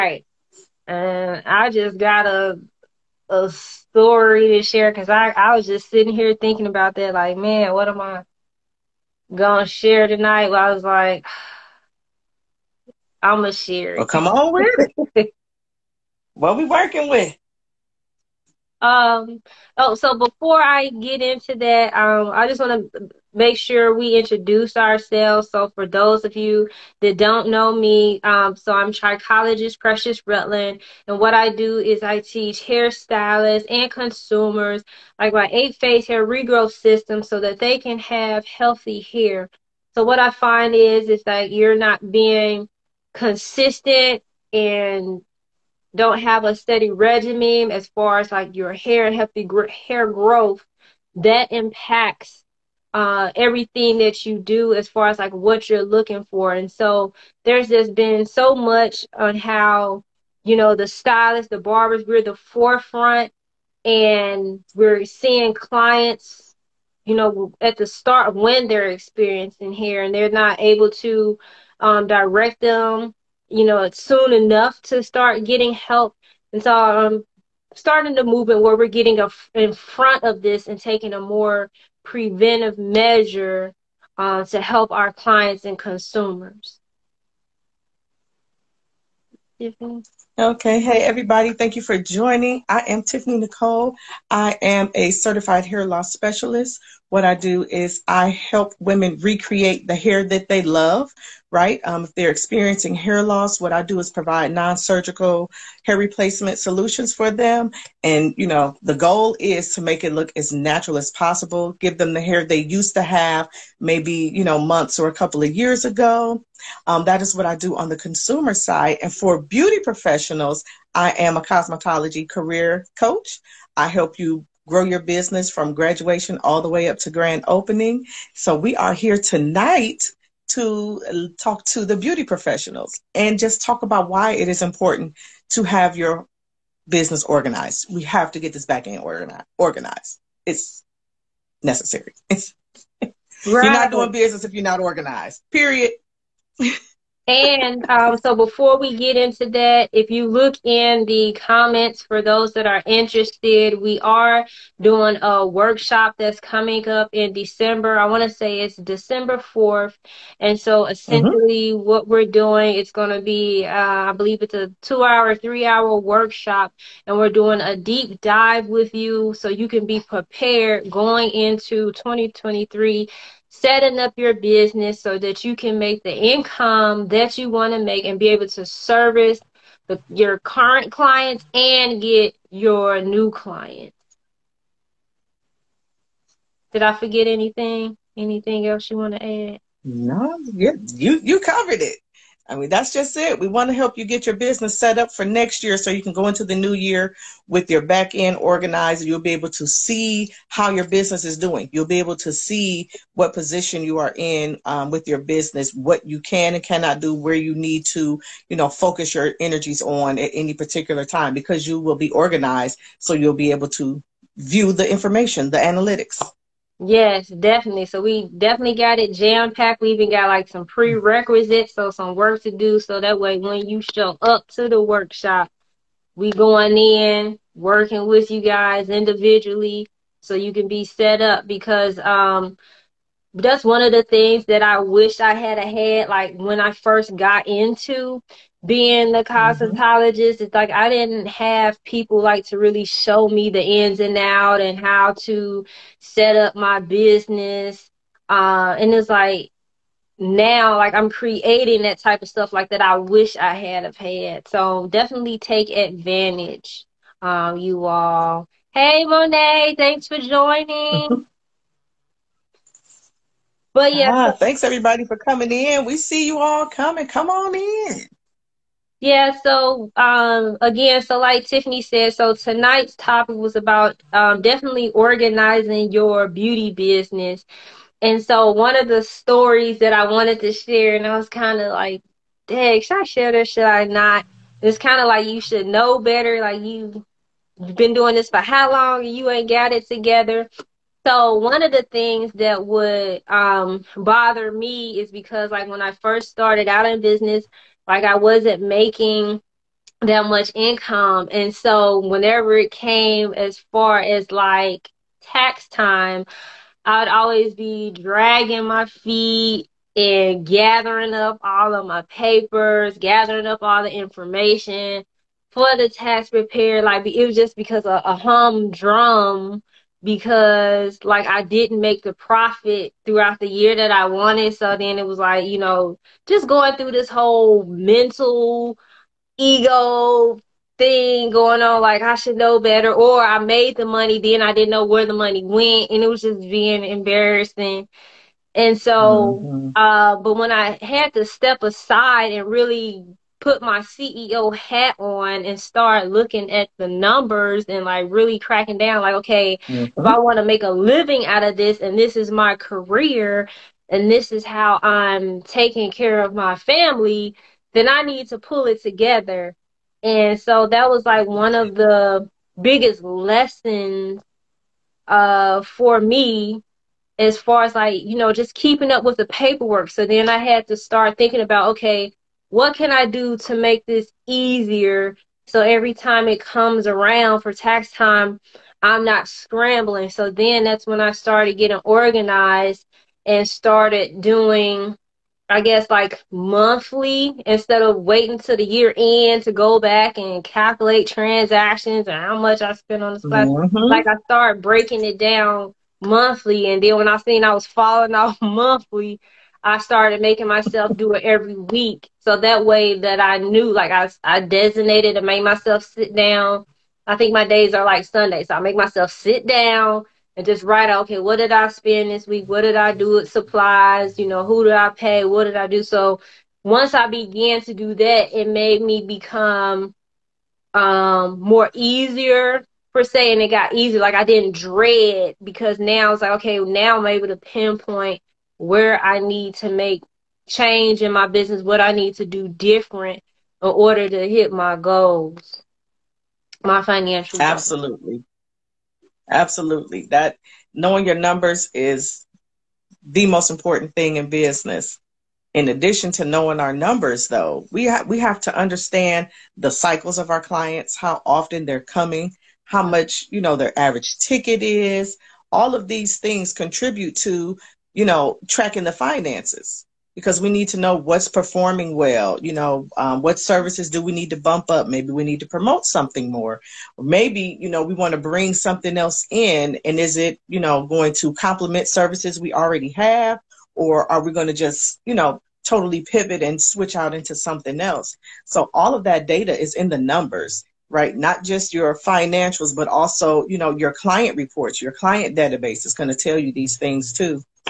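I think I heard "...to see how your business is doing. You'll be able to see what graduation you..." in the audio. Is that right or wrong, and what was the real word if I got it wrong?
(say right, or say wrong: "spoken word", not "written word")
wrong: "position", not "graduation".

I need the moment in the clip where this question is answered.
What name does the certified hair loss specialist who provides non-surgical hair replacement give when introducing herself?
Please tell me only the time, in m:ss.
1:33.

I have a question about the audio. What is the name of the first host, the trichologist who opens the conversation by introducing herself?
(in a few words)
Precious Rutlin.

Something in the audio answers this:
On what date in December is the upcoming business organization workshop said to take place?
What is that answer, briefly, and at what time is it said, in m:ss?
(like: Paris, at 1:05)
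December 4th, at 2:38.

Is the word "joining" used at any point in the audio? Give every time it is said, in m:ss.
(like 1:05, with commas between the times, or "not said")
1:31, 4:20.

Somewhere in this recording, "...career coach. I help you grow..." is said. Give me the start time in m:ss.
2:02.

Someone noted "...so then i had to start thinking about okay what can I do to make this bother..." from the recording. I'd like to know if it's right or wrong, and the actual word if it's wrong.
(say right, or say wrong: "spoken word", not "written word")
wrong: "easier", not "bother".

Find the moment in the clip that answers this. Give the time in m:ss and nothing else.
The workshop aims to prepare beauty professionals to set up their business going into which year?
2:51.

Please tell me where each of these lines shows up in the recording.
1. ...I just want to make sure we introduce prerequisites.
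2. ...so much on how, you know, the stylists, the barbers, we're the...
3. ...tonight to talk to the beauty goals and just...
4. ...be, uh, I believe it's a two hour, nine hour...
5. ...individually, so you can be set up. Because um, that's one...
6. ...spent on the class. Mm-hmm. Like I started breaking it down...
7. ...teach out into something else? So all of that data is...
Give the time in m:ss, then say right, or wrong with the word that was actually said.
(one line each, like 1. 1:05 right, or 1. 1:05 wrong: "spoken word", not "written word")
1. 0:22 wrong: "ourselves", not "prerequisites"
2. 0:58 right
3. 2:09 wrong: "professionals", not "goals"
4. 2:43 wrong: "three", not "nine"
5. 3:48 right
6. 6:32 right
7. 7:56 wrong: "switch", not "teach".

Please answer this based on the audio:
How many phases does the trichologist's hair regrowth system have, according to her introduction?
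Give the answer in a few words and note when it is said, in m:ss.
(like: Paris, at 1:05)
8, at 0:35.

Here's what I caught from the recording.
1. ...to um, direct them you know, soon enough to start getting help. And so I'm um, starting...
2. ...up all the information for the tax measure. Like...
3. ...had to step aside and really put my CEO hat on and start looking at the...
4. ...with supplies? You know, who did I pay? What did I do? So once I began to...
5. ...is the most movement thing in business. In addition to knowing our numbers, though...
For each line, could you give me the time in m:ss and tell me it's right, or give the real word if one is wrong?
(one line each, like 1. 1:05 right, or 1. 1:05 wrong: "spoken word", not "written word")
1. 1:10 right
2. 5:13 wrong: "prepare", not "measure"
3. 5:40 right
4. 6:53 right
5. 7:21 wrong: "important", not "movement".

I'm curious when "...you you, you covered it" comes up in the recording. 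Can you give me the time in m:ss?
3:10.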